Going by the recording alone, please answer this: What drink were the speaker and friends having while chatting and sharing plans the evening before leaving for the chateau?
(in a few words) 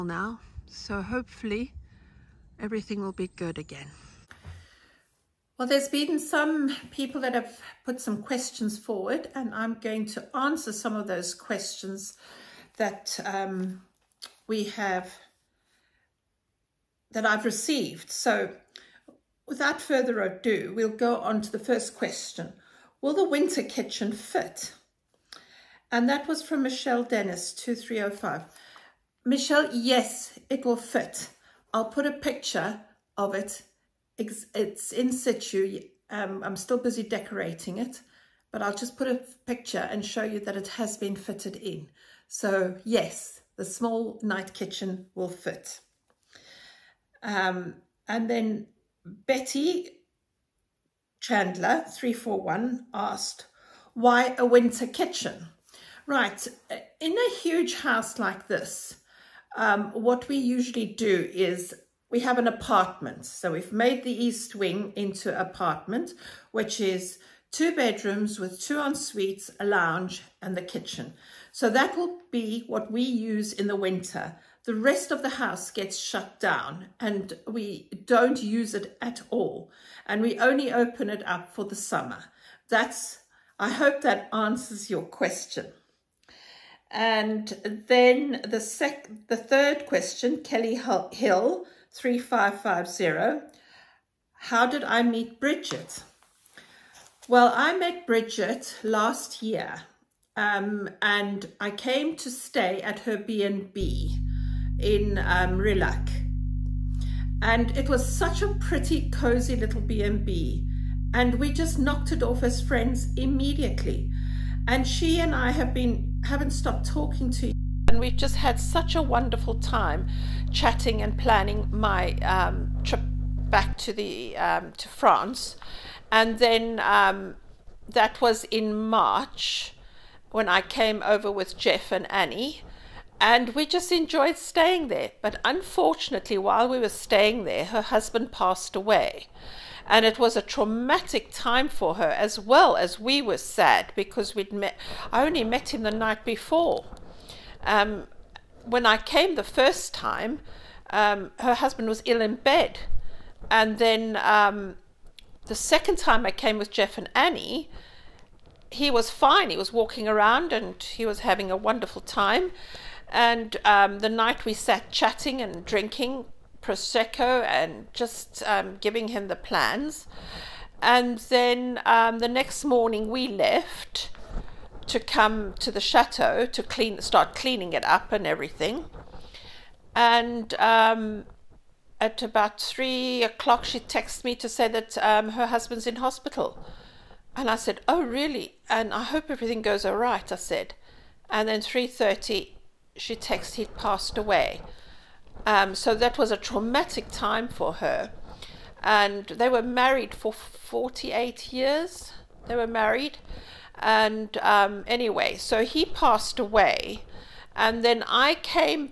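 Prosecco.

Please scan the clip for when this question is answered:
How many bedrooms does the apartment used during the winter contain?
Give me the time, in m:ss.
1:07.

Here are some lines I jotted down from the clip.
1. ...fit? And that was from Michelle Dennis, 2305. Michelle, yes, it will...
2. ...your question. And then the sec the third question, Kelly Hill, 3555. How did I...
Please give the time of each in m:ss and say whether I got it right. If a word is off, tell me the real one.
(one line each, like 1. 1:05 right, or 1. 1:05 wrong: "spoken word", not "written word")
1. 0:24 right
2. 1:24 wrong: "3550", not "3555".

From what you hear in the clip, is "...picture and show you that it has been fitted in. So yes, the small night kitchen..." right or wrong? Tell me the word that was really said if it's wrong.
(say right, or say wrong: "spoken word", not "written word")
right.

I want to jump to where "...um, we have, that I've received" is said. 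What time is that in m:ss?
0:13.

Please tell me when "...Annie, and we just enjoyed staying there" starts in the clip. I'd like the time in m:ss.
2:12.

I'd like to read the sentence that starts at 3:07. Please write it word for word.
And I said, "Oh, really?" And I hope everything goes all right.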